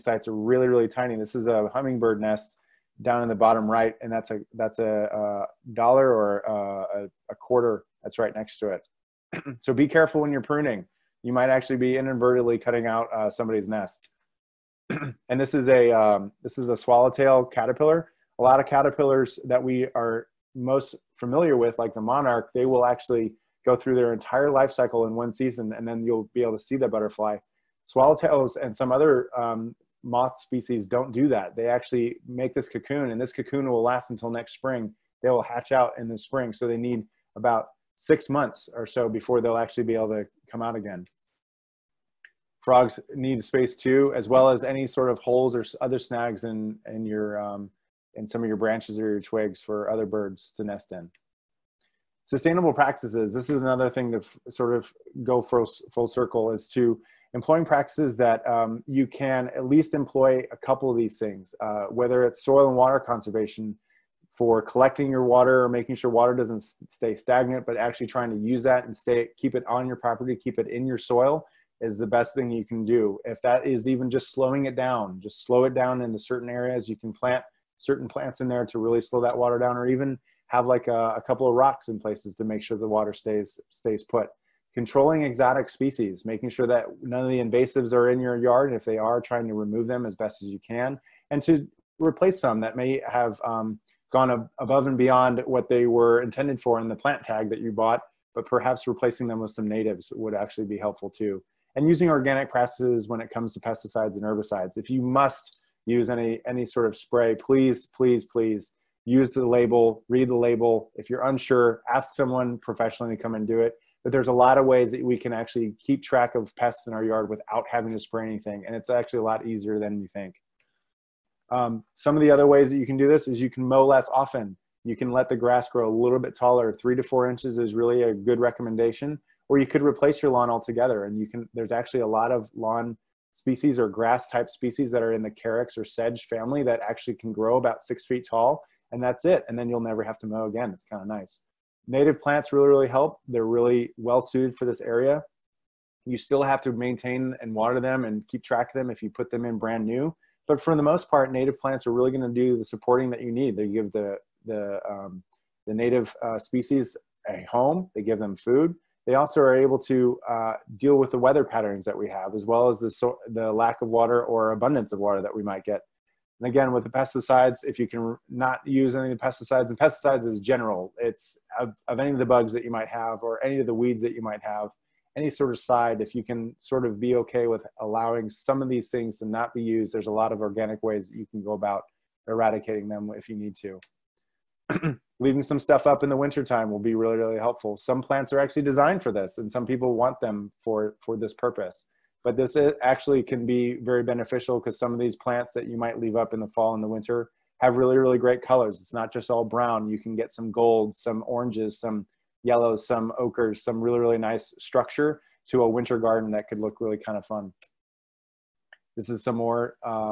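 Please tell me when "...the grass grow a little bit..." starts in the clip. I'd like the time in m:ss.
2:05.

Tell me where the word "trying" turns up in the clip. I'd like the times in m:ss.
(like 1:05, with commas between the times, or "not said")
1:08, 1:29.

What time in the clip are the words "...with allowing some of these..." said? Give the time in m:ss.
2:57.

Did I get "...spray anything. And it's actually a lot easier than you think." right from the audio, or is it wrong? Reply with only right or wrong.
right.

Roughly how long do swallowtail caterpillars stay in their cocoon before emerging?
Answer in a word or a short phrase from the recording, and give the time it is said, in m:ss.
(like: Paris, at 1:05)
about 6 months, at 0:37.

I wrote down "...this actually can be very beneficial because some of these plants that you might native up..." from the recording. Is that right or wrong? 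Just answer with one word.
wrong.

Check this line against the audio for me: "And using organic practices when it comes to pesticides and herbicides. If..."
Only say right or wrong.
right.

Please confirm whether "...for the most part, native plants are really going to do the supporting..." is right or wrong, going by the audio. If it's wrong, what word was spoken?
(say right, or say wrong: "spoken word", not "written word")
right.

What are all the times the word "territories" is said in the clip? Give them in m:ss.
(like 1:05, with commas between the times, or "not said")
not said.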